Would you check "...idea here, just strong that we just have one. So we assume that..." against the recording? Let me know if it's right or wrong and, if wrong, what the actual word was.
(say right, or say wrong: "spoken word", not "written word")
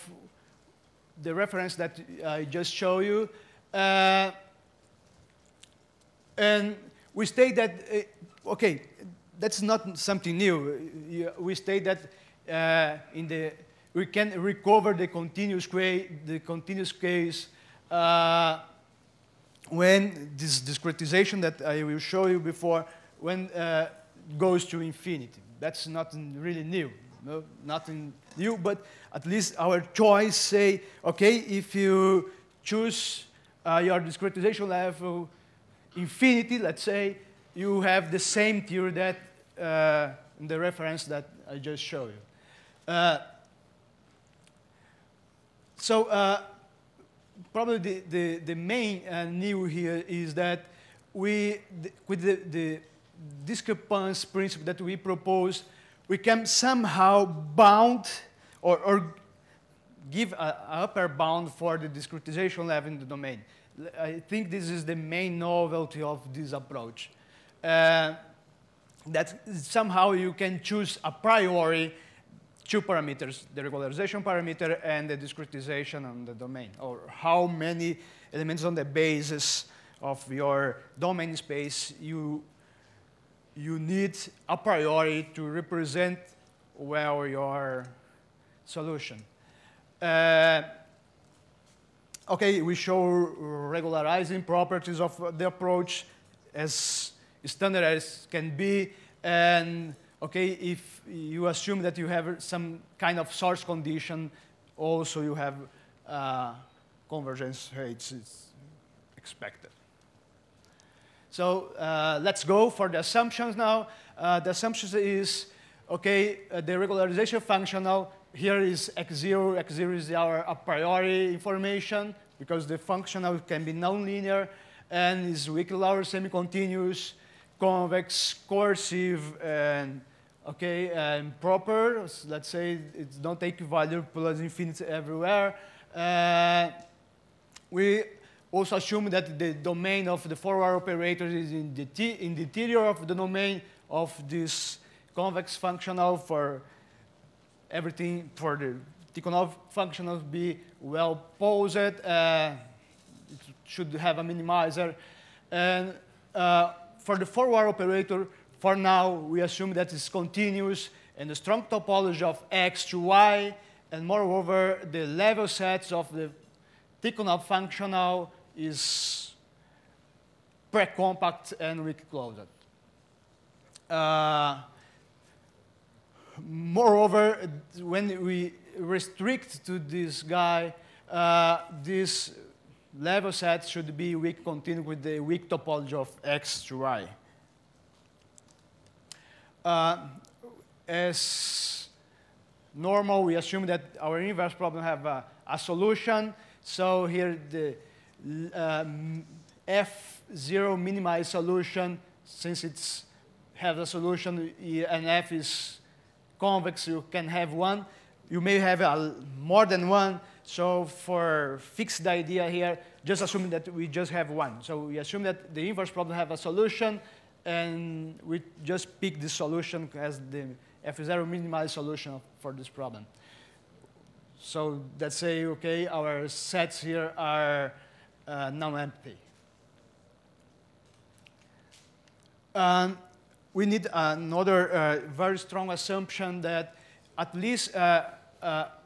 wrong: "assuming", not "strong".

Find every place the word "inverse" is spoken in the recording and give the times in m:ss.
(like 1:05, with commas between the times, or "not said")
3:14, 3:35.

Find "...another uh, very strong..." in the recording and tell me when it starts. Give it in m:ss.
3:53.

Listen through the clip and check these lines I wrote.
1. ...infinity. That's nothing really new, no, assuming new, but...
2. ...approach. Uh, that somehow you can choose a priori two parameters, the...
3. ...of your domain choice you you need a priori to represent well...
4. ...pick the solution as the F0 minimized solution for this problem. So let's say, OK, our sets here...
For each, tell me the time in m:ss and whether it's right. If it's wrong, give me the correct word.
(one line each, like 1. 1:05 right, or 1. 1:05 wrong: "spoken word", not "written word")
1. 0:24 wrong: "nothing", not "assuming"
2. 1:06 right
3. 1:20 wrong: "space", not "choice"
4. 3:39 right.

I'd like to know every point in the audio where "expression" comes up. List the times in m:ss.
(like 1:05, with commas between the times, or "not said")
not said.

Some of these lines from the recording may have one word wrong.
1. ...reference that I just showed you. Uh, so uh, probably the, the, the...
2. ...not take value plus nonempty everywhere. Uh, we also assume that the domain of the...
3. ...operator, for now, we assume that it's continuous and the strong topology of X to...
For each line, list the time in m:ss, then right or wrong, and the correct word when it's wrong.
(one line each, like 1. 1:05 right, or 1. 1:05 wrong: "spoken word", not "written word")
1. 0:40 right
2. 2:13 wrong: "infinity", not "nonempty"
3. 2:37 right.